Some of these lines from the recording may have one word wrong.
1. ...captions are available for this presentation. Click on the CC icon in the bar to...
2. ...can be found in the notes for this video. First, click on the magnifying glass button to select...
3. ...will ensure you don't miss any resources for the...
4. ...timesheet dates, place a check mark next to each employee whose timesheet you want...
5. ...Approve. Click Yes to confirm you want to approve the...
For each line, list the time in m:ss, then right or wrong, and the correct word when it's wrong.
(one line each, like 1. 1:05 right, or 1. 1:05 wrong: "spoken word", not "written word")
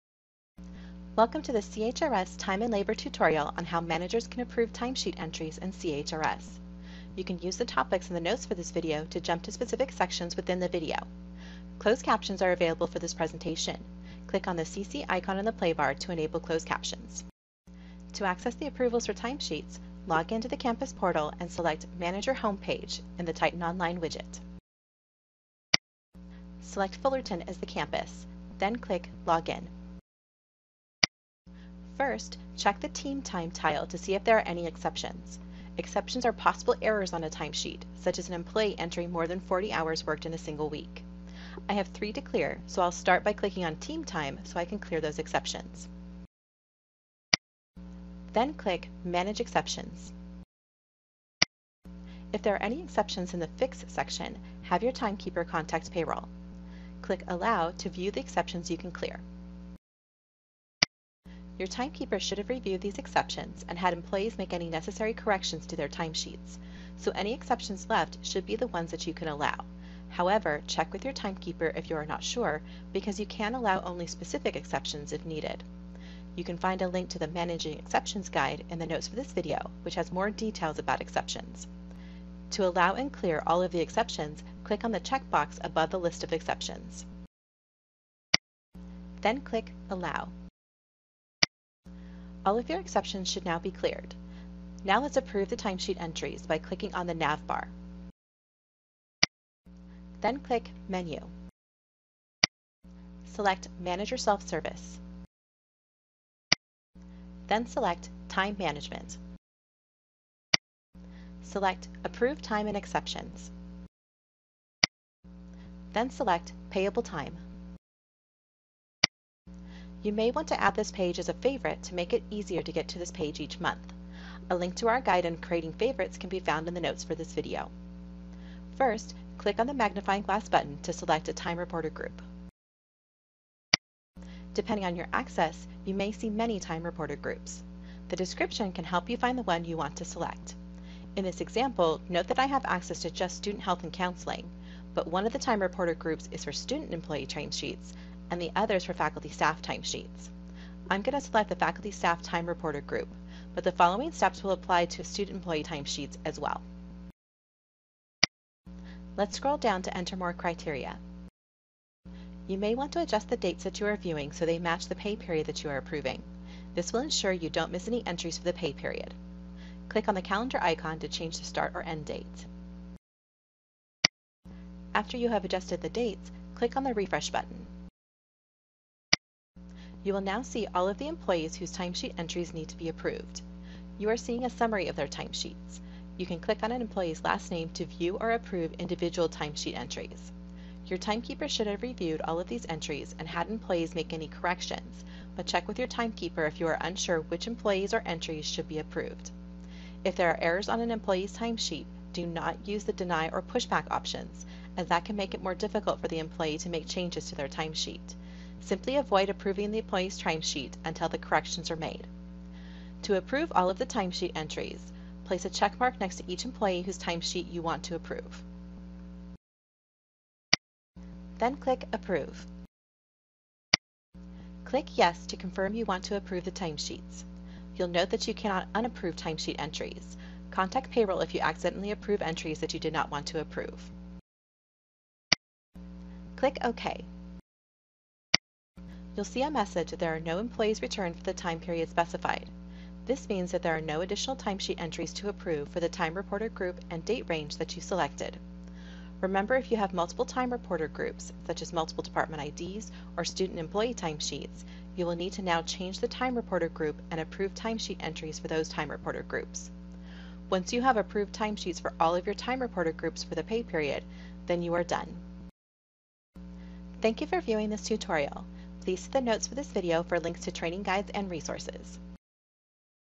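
1. 0:12 right
2. 2:06 right
3. 2:46 wrong: "entries", not "resources"
4. 3:33 wrong: "entries", not "dates"
5. 3:41 right.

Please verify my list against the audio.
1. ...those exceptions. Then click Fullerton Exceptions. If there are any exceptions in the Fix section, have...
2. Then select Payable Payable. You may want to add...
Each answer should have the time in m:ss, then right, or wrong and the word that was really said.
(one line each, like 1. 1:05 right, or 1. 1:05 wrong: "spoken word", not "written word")
1. 0:44 wrong: "Manage", not "Fullerton"
2. 1:55 wrong: "Time", not "Payable".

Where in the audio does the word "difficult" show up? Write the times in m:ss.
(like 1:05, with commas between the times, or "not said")
3:25.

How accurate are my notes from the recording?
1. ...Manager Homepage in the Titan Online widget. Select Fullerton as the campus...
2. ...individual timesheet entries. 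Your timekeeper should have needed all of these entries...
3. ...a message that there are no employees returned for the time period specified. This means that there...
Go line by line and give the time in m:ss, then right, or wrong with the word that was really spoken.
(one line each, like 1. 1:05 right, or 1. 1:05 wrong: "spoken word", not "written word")
1. 0:21 right
2. 3:08 wrong: "reviewed", not "needed"
3. 3:59 right.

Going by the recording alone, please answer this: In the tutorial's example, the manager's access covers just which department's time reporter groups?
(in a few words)
student health and counseling.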